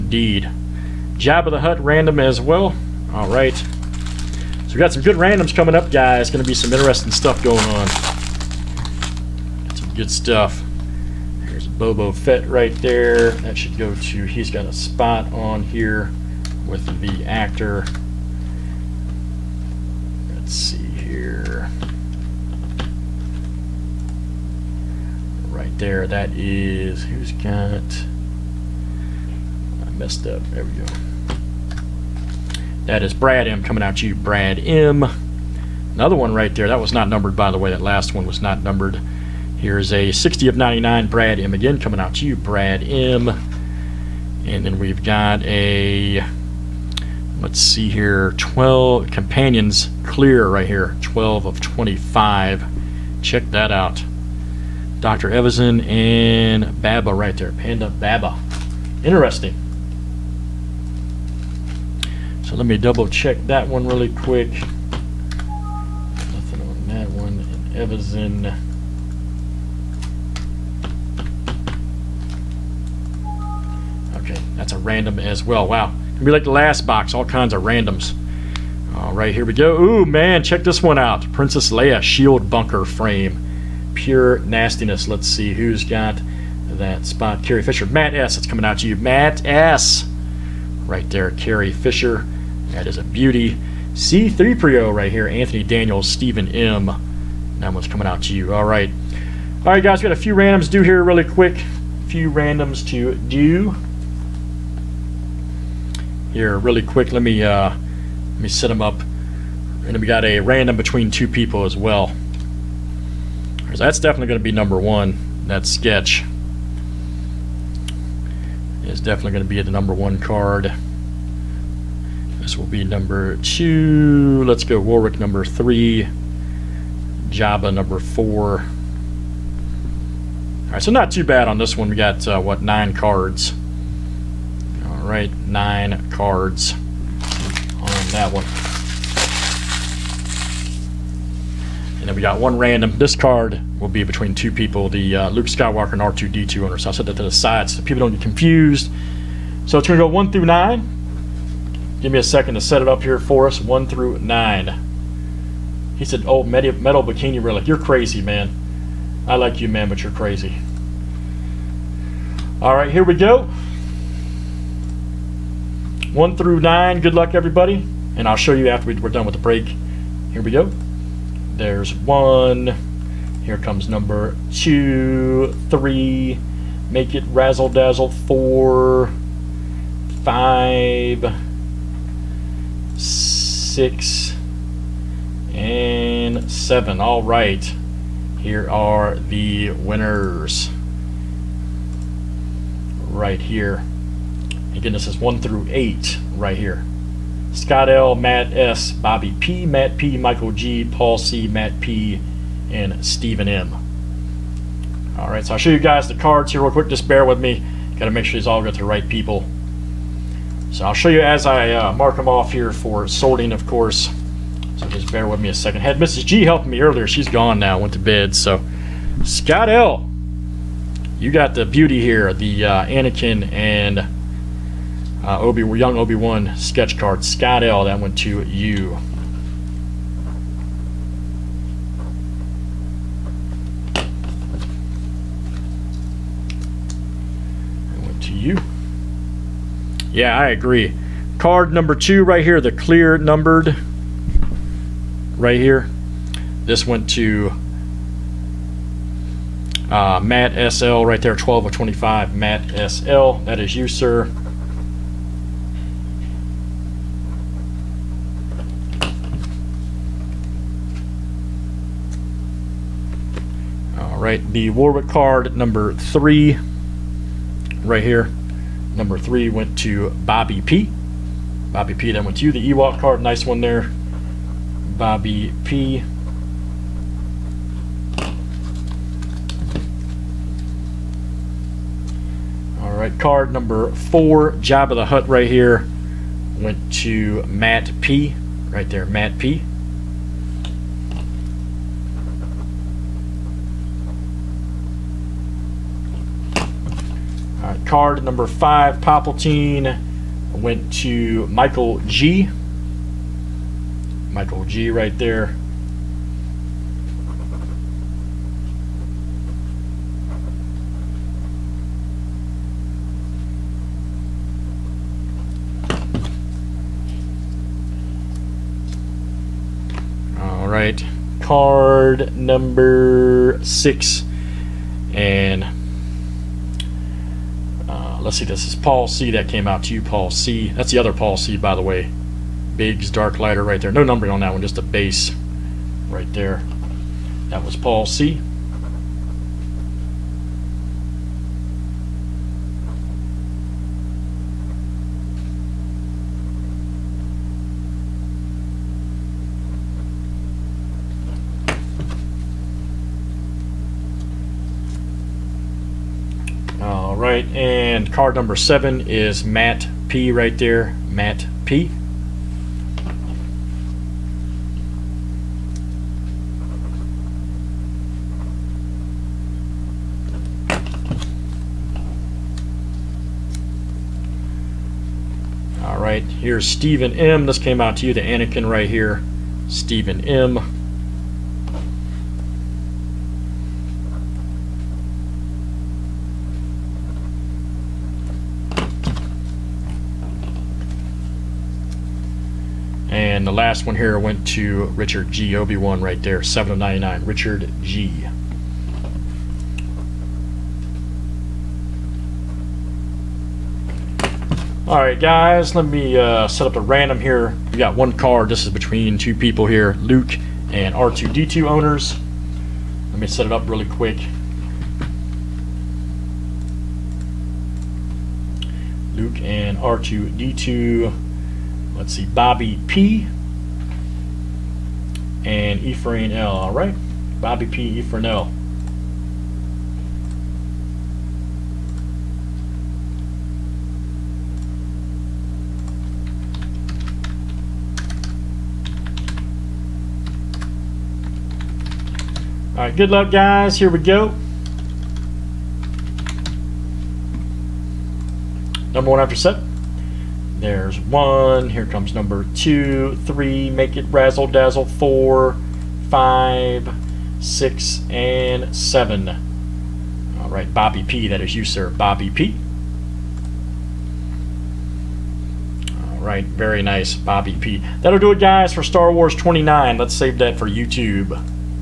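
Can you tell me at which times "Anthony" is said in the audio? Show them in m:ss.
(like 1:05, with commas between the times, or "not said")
1:35.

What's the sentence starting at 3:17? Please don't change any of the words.
Scott L, Matt S, Bobby P, Matt P, Michael G, Paul C, Matt P, and Stephen M.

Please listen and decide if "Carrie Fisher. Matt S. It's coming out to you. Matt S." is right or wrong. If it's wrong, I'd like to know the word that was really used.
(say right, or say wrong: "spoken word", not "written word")
right.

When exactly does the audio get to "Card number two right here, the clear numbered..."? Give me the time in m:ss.
4:01.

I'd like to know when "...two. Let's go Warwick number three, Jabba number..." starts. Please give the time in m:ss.
2:03.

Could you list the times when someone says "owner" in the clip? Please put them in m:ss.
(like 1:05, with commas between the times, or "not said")
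2:26, 6:51.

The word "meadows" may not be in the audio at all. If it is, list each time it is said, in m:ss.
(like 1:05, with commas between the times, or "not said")
not said.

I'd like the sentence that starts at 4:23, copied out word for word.
All right, the Warwick card number three right here.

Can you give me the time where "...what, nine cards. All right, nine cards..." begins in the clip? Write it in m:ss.
2:12.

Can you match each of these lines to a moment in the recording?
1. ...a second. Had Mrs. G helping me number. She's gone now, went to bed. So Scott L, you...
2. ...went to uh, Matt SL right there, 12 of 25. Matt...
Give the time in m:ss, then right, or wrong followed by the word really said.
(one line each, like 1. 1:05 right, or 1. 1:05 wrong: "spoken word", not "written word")
1. 3:35 wrong: "earlier", not "number"
2. 4:06 right.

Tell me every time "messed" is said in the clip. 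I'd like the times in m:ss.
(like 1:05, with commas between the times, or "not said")
0:29.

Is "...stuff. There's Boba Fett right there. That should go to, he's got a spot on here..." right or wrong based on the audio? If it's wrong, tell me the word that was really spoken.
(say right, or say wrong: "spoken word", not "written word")
right.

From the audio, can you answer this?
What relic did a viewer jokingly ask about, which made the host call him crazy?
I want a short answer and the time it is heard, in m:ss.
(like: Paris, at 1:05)
Metal bikini relic, at 2:36.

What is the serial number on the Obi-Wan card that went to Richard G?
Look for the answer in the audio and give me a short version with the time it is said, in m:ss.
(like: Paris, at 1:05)
7 of 99, at 6:36.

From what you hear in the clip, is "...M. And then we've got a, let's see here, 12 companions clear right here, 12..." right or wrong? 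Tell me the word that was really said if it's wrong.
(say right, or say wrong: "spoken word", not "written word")
right.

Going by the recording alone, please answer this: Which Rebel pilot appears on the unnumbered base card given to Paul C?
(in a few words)
Biggs Darklighter.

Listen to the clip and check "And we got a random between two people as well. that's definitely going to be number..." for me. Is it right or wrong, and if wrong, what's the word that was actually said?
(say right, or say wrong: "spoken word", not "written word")
right.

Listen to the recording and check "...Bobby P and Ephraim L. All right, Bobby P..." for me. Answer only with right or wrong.
right.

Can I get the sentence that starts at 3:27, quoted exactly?
Got to make sure these all go to the right people.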